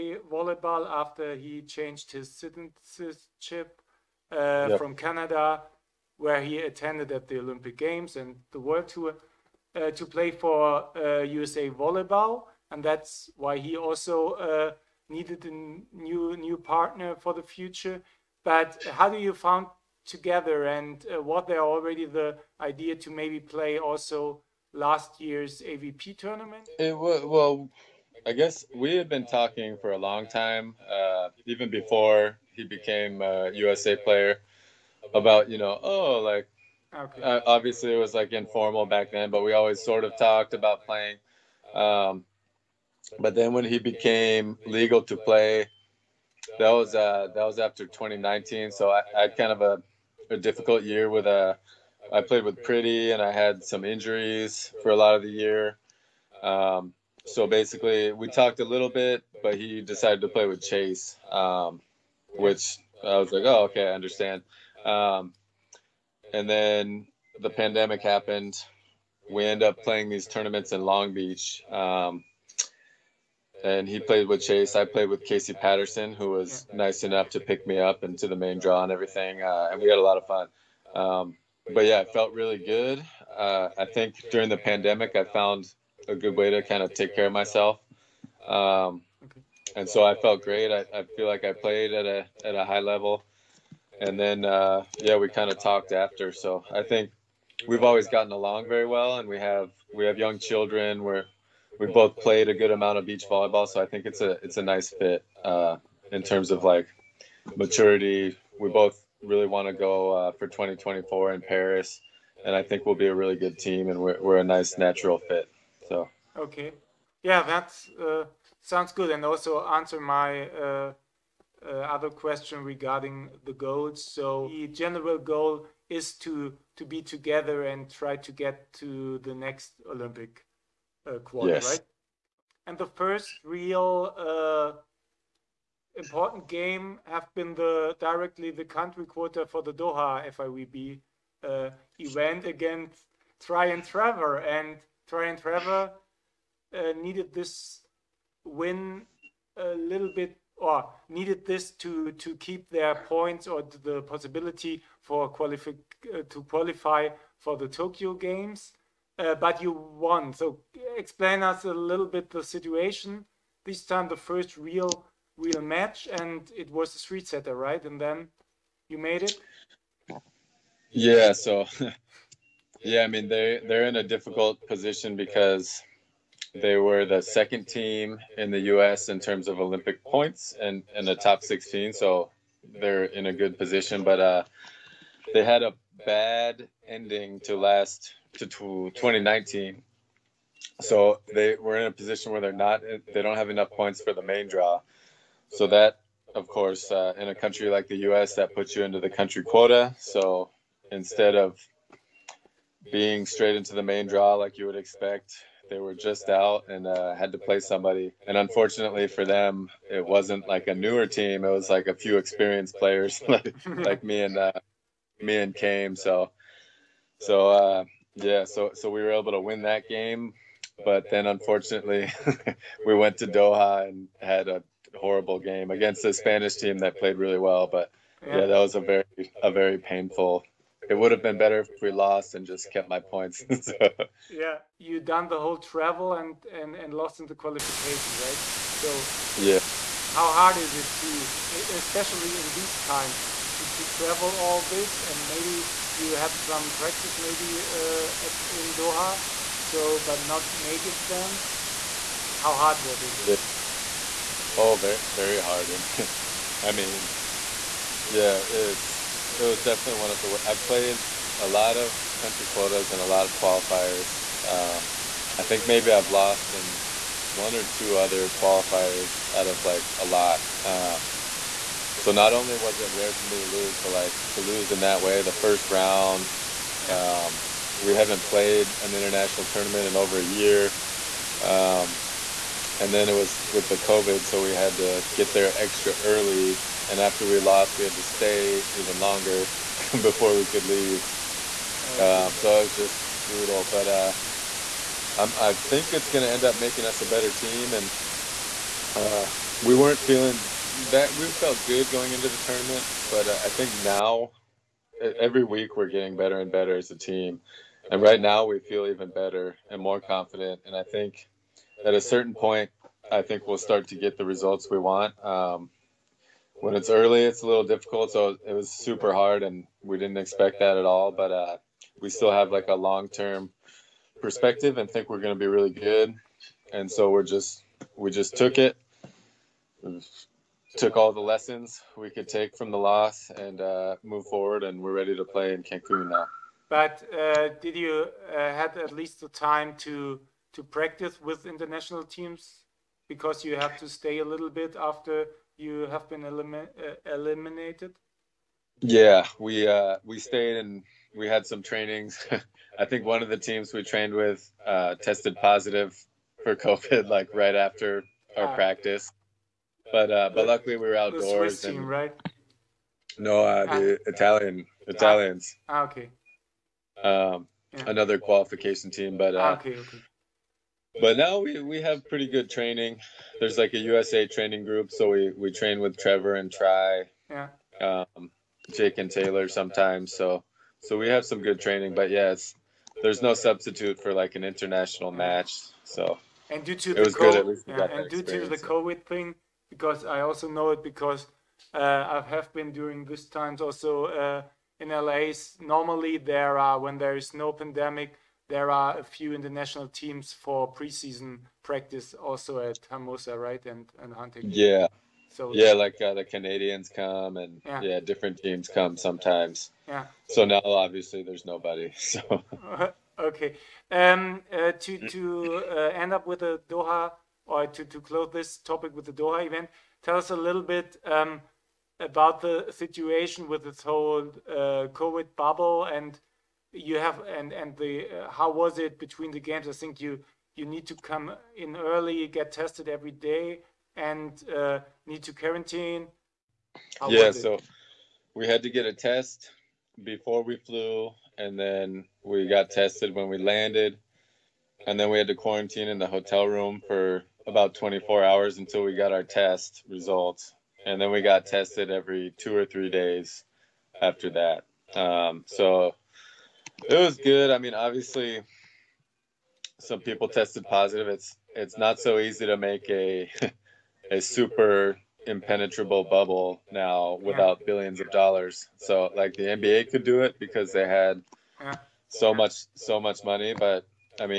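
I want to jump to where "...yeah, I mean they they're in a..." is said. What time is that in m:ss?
2:52.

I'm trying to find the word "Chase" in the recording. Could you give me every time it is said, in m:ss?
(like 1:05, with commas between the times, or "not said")
1:00, 1:14.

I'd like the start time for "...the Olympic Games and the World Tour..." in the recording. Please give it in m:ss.
0:07.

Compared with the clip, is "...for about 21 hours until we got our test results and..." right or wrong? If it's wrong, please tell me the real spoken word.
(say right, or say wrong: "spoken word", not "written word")
wrong: "24", not "21".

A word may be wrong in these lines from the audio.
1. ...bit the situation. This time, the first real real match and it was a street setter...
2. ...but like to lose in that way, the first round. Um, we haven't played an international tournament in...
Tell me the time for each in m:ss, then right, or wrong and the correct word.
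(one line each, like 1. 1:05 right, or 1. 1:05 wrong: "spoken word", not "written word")
1. 2:42 right
2. 4:33 right.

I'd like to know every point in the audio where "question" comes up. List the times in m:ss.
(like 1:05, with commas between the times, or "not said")
2:02.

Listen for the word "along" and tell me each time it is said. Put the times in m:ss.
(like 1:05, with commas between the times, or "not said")
1:38.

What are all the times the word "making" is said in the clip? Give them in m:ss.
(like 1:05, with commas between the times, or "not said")
4:10, 4:56.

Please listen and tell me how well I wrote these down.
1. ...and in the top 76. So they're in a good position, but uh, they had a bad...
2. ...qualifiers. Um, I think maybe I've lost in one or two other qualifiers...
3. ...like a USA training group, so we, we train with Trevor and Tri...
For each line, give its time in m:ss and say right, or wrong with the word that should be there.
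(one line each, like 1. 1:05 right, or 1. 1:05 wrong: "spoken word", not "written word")
1. 3:00 wrong: "16", not "76"
2. 4:23 right
3. 6:13 right.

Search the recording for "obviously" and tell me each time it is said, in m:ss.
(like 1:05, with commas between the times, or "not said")
0:37, 6:50, 7:37.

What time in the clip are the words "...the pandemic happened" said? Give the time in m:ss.
1:07.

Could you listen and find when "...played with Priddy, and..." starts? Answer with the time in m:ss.
0:52.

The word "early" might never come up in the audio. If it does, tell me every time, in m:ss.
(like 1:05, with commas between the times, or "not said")
4:45, 5:16, 7:11.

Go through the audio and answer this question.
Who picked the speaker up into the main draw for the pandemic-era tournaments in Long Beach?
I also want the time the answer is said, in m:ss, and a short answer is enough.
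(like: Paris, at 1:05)
Casey Patterson, at 1:15.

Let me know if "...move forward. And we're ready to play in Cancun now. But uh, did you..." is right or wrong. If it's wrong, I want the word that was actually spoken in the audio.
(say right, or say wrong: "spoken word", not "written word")
right.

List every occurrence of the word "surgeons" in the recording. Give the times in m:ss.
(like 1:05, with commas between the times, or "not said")
not said.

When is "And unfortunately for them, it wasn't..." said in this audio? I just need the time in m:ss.
3:28.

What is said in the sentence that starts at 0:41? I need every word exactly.
Um, but then when he became legal to play, that was uh, that was after 2019.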